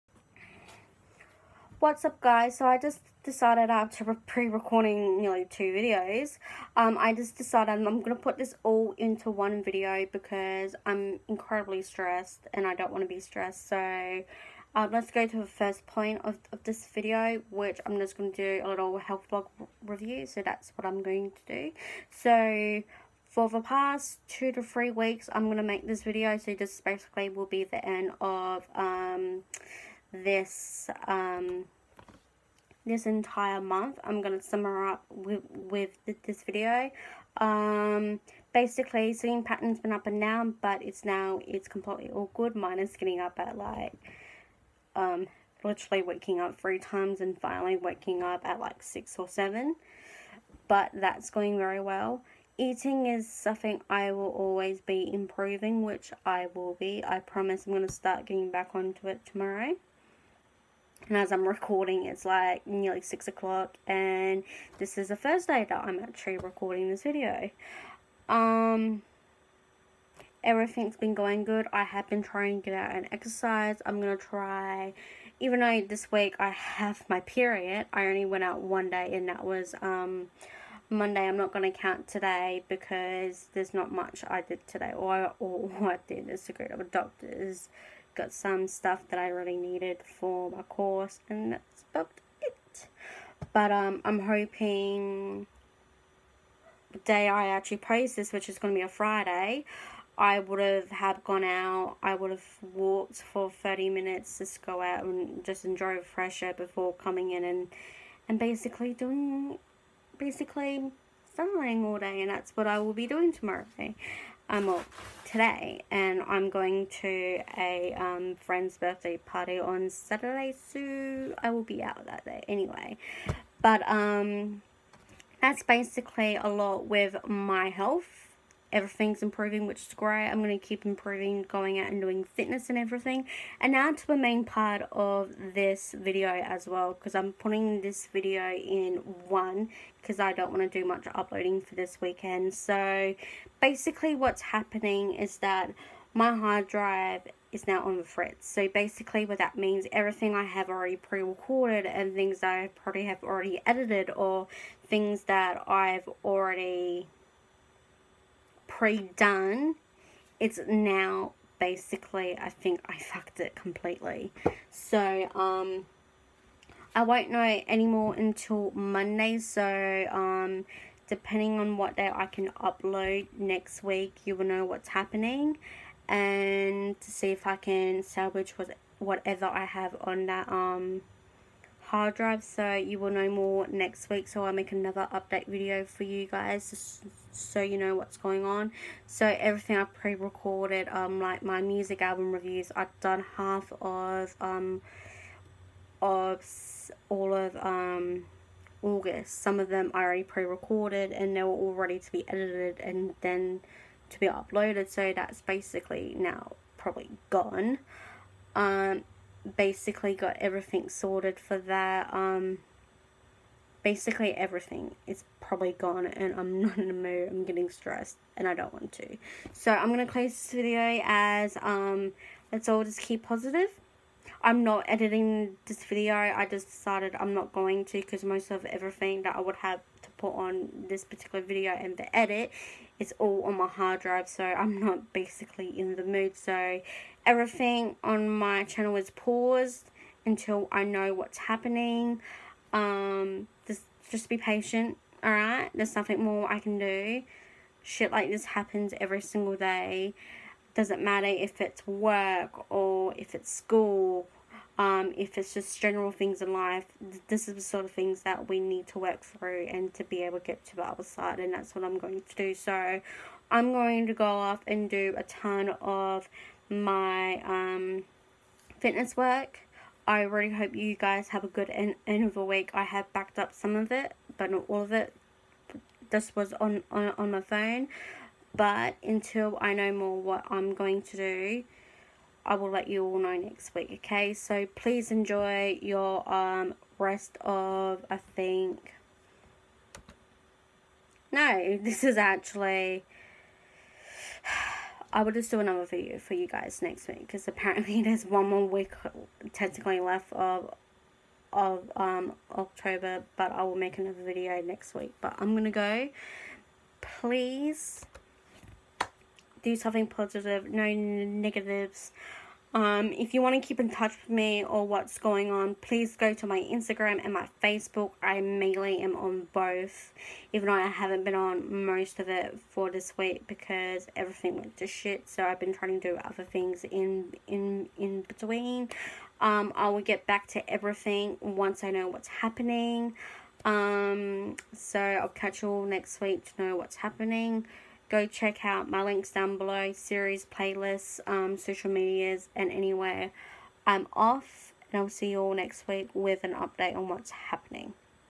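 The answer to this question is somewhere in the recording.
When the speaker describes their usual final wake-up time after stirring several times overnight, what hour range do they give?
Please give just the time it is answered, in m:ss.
0:48.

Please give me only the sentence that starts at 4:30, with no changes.
I really hope you guys have a good end, end of the week.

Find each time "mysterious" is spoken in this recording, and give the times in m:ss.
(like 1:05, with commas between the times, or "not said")
not said.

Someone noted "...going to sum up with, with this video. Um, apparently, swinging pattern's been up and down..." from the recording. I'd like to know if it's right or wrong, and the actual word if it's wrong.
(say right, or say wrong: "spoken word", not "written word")
wrong: "basically", not "apparently".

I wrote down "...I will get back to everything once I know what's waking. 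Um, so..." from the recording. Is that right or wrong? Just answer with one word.
wrong.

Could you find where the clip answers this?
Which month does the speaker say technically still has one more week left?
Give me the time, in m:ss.
5:02.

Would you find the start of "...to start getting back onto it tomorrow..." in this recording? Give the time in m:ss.
0:57.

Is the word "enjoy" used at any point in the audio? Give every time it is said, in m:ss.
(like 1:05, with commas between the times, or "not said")
1:45, 4:45.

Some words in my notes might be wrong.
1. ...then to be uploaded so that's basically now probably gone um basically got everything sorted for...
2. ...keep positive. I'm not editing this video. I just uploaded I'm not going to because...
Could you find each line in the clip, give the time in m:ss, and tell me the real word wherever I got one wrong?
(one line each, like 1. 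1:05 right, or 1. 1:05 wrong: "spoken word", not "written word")
1. 3:23 right
2. 3:42 wrong: "decided", not "uploaded".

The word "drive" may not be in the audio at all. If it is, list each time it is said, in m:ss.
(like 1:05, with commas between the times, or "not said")
2:26, 3:02, 3:53.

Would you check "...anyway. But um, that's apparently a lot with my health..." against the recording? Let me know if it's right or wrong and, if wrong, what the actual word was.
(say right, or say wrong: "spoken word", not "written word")
wrong: "basically", not "apparently".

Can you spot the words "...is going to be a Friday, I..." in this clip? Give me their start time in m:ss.
1:38.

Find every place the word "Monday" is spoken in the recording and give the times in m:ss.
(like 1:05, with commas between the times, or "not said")
1:20, 2:48.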